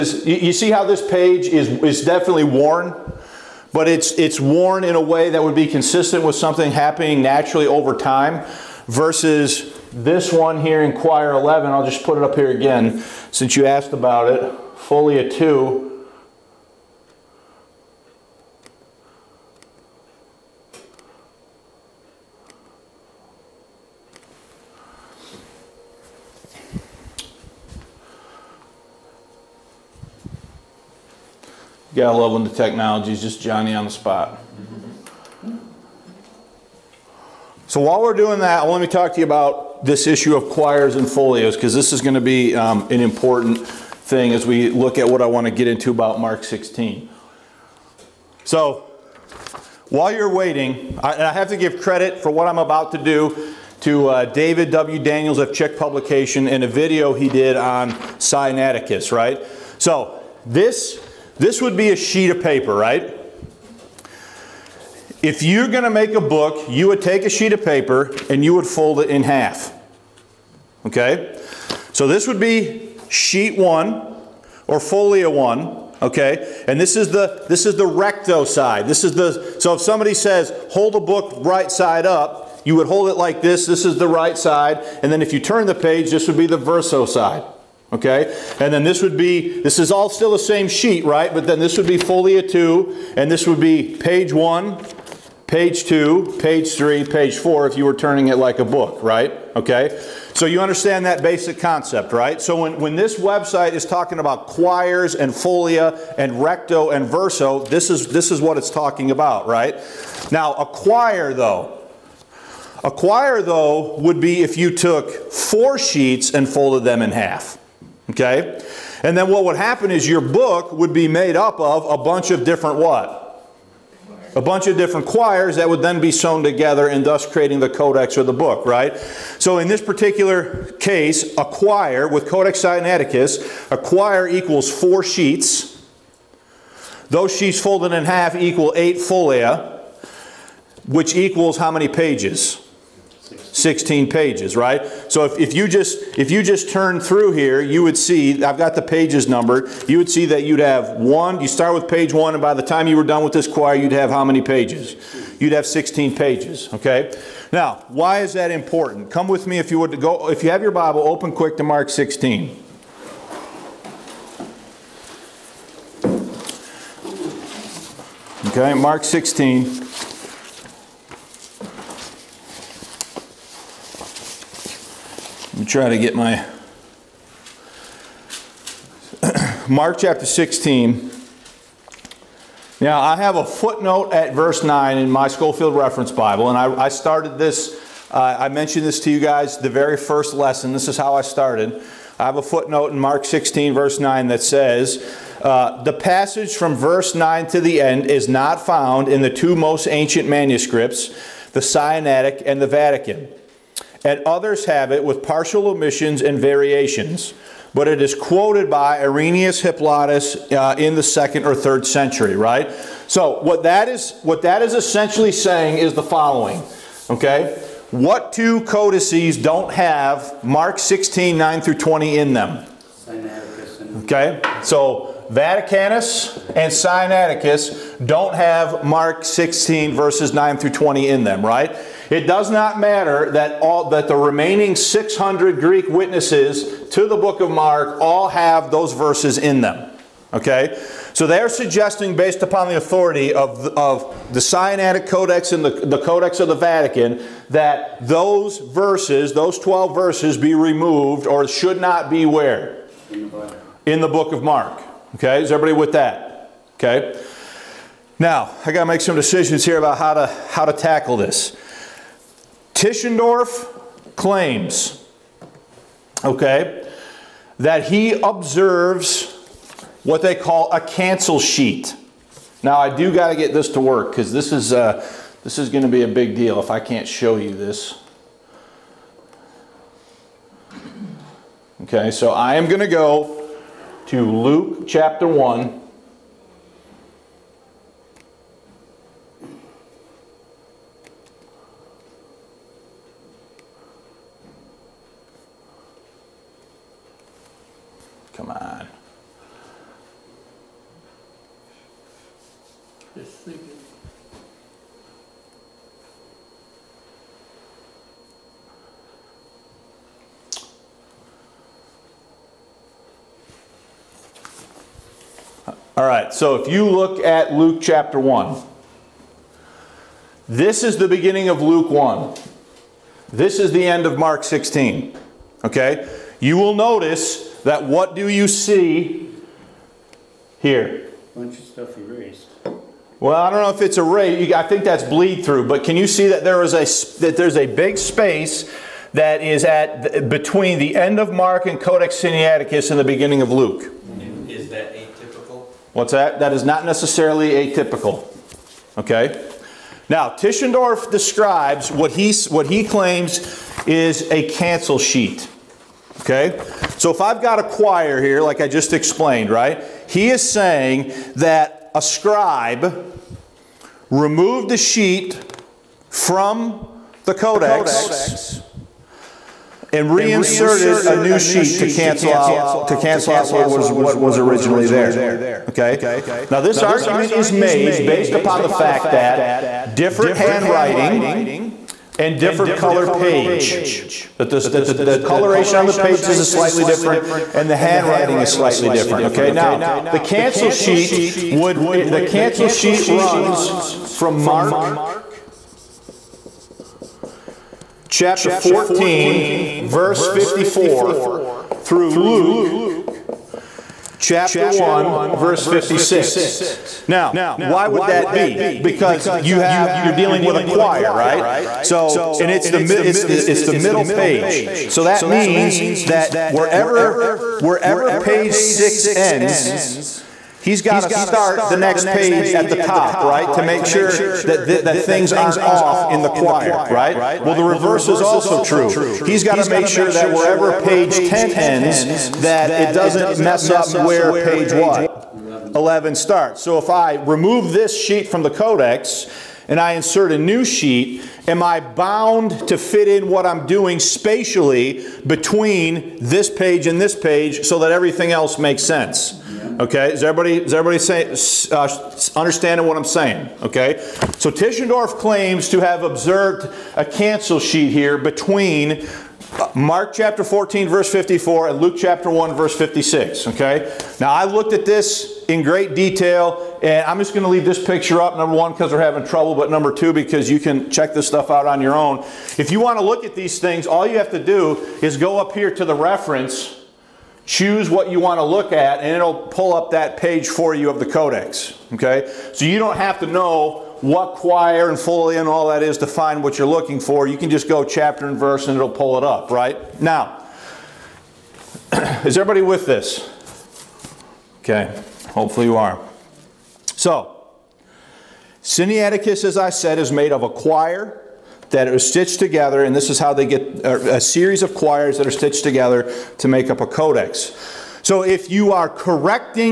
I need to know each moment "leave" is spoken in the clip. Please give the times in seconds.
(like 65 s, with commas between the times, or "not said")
467 s.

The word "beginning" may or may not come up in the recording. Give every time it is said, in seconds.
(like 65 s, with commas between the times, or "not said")
321 s, 343 s.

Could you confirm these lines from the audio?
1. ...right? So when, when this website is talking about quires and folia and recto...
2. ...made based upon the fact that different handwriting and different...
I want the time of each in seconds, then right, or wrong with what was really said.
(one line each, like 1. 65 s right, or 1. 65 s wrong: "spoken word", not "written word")
1. 102 s right
2. 377 s right.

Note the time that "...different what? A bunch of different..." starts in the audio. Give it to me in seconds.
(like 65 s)
122 s.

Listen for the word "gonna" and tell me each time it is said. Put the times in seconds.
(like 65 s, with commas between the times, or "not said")
275 s, 282 s.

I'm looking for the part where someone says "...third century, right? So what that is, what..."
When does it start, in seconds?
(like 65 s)
211 s.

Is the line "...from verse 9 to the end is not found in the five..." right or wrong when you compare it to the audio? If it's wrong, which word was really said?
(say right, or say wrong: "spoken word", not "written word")
wrong: "two", not "five".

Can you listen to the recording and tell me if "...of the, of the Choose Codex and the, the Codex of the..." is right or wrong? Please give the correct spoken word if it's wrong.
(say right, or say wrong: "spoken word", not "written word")
wrong: "Sinaitic", not "Choose".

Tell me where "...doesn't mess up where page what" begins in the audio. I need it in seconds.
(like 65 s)
432 s.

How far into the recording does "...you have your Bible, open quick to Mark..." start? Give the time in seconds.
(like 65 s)
160 s.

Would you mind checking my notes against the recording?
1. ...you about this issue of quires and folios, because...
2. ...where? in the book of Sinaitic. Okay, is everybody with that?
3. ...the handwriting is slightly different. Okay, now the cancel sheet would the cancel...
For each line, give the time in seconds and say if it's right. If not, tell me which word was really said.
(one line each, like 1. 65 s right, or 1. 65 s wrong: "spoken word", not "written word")
1. 39 s right
2. 252 s wrong: "Mark", not "Sinaitic"
3. 387 s right.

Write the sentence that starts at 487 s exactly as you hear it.
You can just go chapter and verse and it'll pull it up, right?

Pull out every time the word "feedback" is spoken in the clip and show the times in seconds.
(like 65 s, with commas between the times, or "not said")
not said.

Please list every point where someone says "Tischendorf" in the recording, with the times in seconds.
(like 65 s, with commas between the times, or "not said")
262 s, 350 s, 454 s.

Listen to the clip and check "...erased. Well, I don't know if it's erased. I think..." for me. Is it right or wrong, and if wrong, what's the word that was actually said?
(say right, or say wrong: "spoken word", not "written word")
right.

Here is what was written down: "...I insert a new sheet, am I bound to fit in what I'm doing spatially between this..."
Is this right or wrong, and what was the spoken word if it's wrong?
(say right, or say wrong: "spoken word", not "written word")
right.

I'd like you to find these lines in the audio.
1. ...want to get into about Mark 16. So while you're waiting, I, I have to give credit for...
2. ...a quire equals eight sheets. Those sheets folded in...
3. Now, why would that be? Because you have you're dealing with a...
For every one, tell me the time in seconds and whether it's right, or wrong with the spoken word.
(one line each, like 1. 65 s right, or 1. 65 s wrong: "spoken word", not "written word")
1. 45 s right
2. 133 s wrong: "four", not "eight"
3. 407 s right.